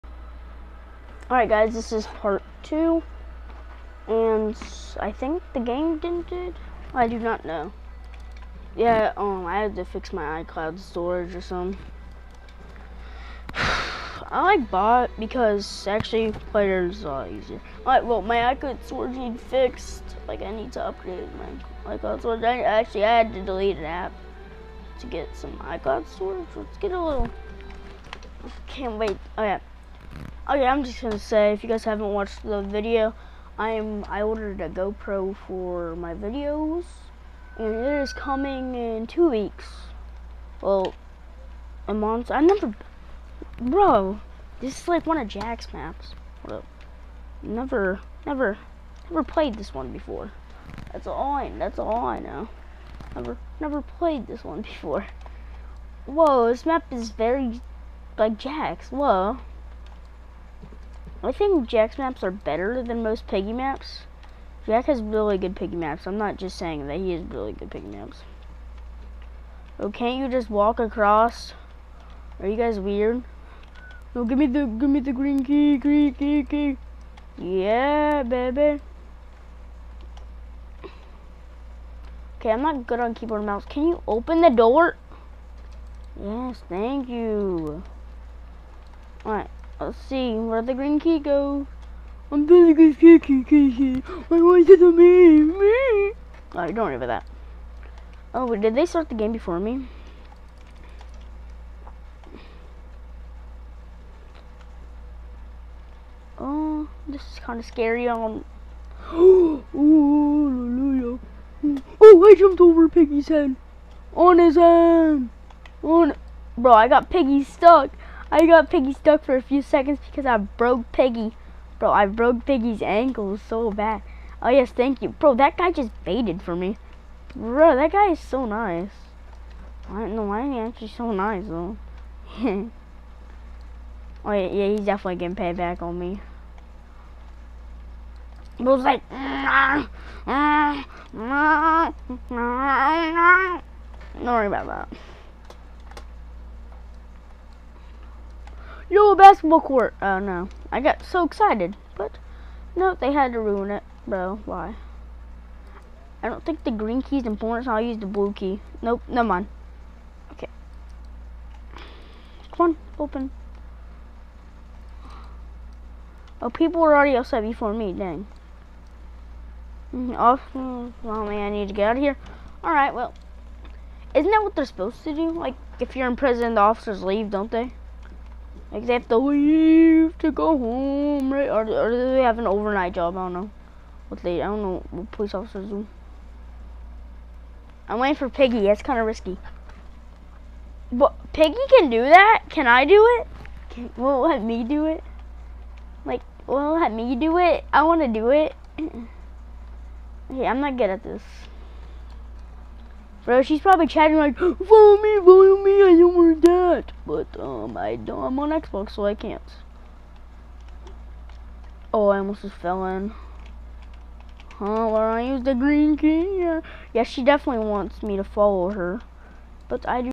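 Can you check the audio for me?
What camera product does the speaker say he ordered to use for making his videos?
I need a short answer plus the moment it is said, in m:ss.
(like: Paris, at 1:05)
GoPro, at 0:34.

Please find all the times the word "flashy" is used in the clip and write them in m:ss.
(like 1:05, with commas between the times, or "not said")
not said.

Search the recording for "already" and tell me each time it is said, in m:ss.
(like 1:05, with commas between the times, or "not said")
2:46.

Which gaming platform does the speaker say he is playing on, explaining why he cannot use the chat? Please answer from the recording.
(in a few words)
Xbox.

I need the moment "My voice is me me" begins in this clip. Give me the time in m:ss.
1:34.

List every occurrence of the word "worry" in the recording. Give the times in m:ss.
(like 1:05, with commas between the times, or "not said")
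1:36, 2:24.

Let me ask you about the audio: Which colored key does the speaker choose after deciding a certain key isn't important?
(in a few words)
Blue key.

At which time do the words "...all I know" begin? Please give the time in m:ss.
0:51.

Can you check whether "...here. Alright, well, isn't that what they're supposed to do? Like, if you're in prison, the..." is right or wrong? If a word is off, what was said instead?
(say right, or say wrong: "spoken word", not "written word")
right.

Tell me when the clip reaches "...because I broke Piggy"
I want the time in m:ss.
2:00.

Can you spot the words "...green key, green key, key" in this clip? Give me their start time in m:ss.
1:15.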